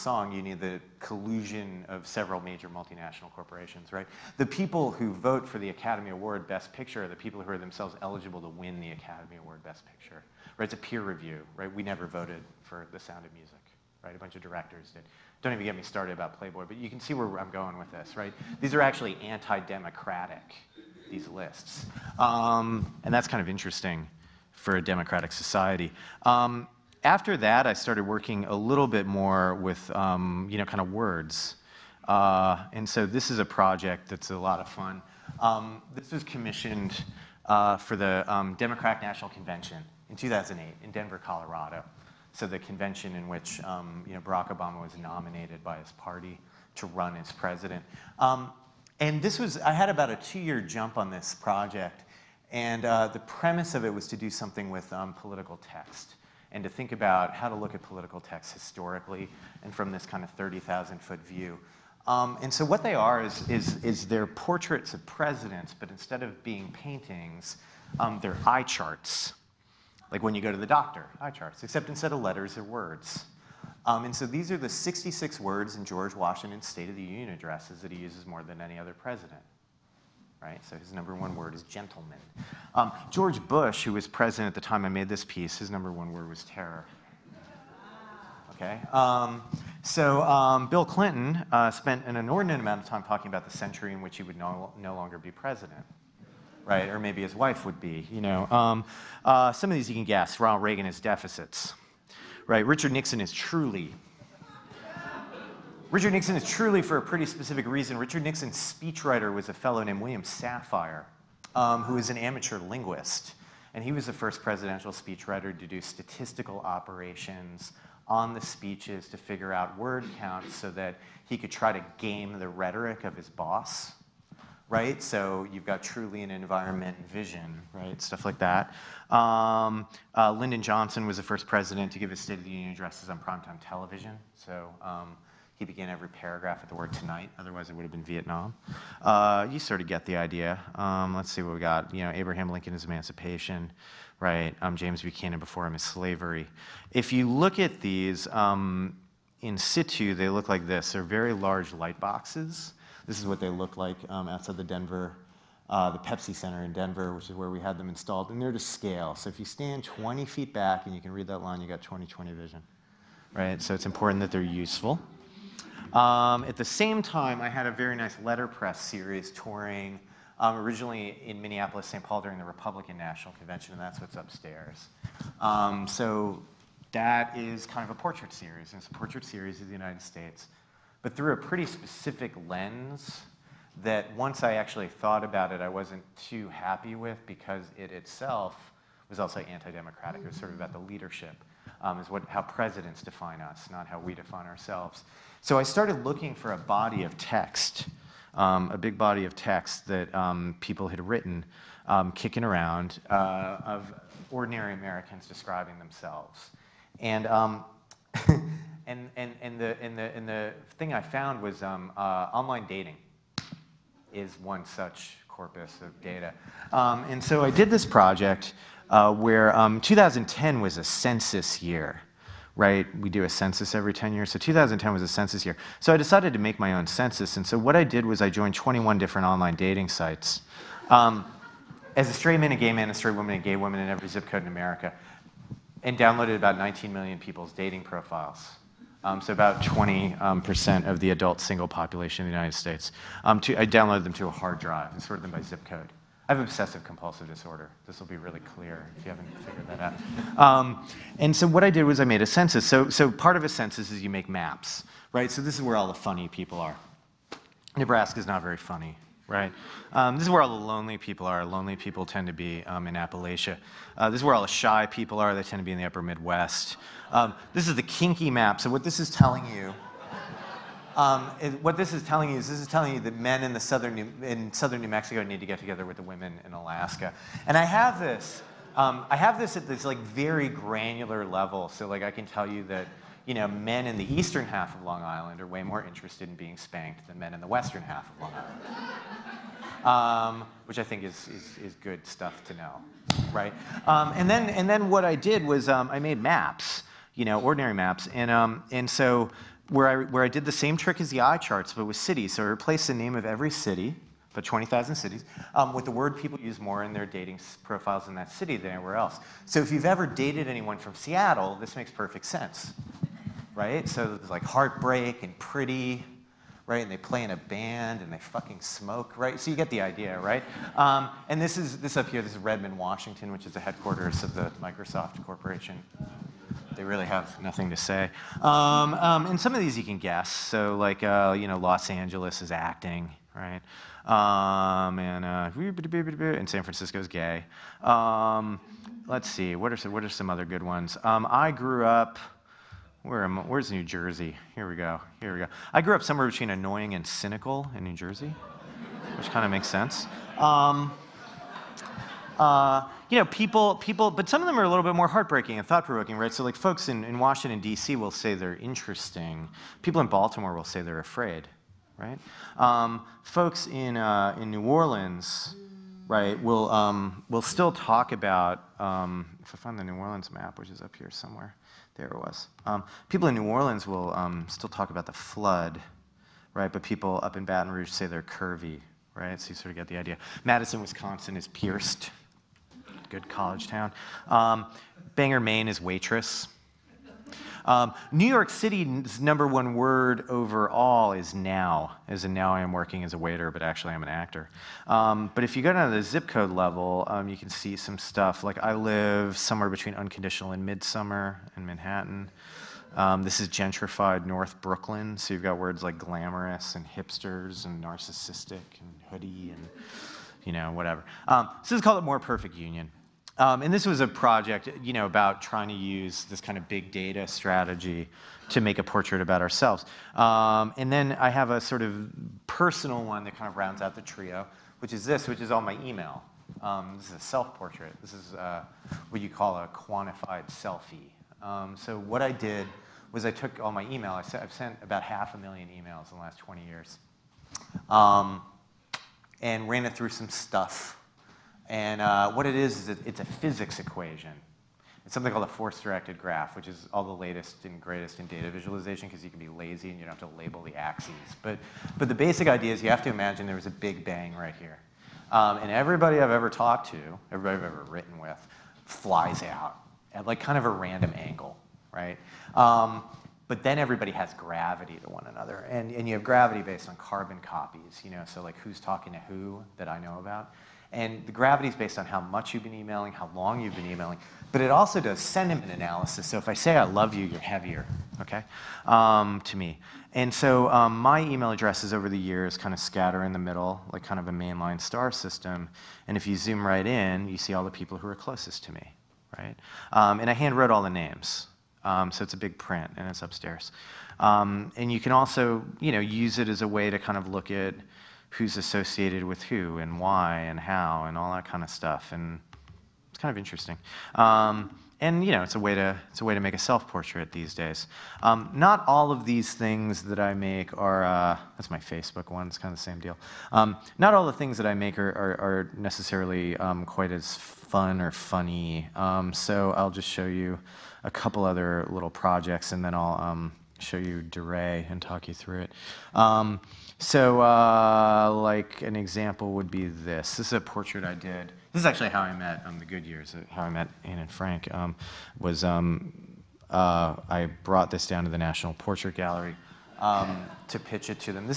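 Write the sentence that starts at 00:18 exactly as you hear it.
These are actually anti-democratic, these lists.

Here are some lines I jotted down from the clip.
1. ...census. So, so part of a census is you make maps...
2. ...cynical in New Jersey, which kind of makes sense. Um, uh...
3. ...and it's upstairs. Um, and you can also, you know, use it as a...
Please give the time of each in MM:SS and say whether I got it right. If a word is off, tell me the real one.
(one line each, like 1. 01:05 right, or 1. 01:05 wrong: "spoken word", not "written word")
1. 04:12 right
2. 05:47 right
3. 08:12 right.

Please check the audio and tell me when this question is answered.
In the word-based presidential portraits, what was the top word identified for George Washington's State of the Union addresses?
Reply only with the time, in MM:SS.
01:21.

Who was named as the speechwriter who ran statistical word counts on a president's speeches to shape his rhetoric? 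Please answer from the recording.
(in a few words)
William Safire.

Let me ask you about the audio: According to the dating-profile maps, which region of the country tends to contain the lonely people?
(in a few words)
Appalachia.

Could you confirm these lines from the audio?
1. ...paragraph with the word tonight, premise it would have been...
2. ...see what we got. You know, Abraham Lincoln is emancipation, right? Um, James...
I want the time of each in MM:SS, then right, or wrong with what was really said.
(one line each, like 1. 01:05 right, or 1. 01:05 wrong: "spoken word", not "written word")
1. 02:16 wrong: "otherwise", not "premise"
2. 02:21 right.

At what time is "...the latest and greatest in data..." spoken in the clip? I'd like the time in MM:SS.
07:27.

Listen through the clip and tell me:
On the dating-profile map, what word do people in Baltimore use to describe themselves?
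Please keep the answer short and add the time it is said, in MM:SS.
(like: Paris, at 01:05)
afraid, at 06:00.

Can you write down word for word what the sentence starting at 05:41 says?
Um, I grew up, where am, where's New Jersey?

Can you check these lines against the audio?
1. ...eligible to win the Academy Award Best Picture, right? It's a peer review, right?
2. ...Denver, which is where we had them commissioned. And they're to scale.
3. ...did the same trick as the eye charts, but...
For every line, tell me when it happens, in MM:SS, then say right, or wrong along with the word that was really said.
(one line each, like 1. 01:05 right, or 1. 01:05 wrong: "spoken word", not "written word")
1. 00:08 right
2. 02:36 wrong: "installed", not "commissioned"
3. 05:00 right.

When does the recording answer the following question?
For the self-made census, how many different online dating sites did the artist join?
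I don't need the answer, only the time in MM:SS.
03:48.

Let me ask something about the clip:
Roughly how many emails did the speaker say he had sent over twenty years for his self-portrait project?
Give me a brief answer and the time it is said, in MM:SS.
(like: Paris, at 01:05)
half a million, at 07:15.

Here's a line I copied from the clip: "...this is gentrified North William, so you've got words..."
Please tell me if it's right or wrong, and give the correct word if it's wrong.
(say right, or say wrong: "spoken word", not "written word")
wrong: "Brooklyn", not "William".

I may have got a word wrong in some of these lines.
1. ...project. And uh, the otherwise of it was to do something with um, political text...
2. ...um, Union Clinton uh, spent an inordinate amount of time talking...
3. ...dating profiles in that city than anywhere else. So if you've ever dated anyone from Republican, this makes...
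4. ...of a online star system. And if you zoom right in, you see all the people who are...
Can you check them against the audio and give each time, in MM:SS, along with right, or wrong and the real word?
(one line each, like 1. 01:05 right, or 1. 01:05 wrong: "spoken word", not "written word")
1. 00:51 wrong: "premise", not "otherwise"
2. 01:30 wrong: "Bill", not "Union"
3. 05:07 wrong: "Seattle", not "Republican"
4. 08:04 wrong: "mainline", not "online".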